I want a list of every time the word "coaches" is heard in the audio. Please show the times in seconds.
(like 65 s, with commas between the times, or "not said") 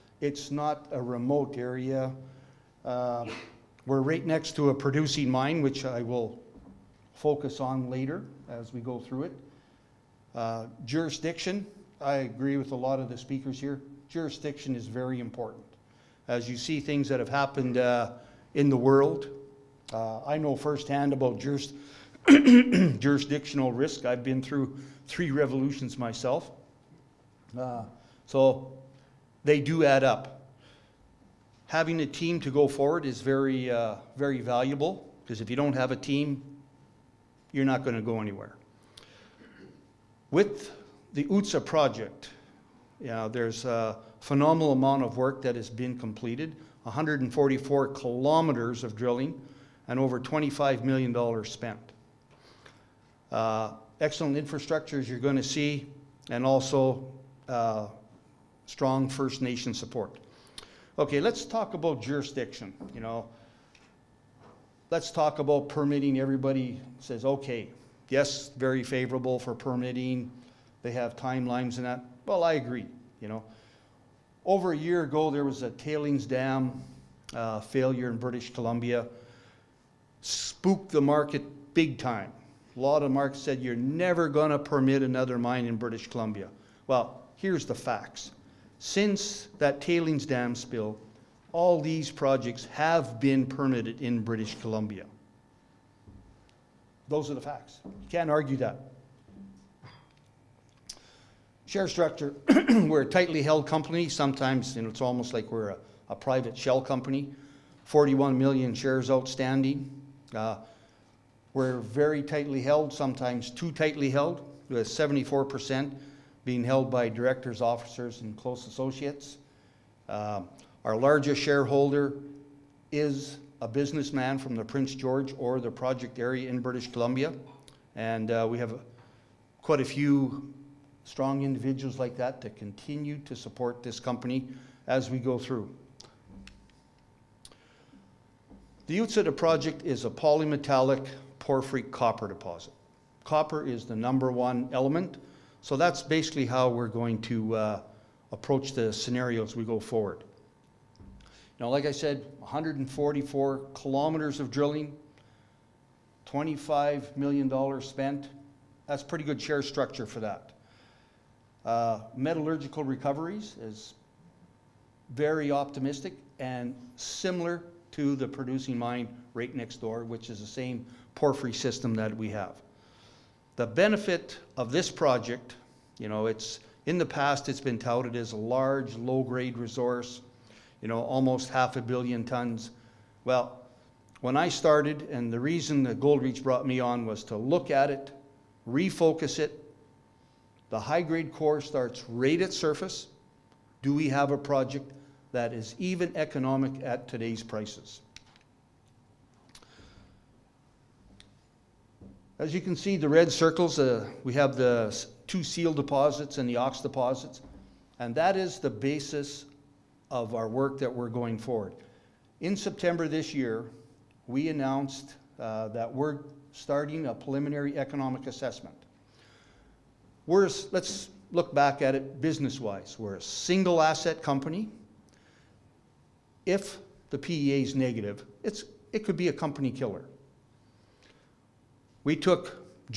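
not said.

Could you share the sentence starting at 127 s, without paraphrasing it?
And uh, we have quite a few strong individuals like that to continue to support this company as we go through.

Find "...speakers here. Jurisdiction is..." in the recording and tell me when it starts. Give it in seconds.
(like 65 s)
13 s.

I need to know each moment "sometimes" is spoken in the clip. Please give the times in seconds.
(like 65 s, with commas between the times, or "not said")
104 s, 112 s.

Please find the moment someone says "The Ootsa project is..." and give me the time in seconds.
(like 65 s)
138 s.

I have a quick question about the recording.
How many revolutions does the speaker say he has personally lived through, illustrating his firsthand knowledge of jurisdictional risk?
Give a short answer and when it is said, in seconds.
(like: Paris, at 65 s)
3, at 25 s.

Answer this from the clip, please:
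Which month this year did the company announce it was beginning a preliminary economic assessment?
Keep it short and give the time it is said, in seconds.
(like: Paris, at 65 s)
September, at 212 s.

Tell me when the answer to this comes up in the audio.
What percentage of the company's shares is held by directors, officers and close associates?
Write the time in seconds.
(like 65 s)
114 s.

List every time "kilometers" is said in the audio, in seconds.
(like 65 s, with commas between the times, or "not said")
47 s, 153 s.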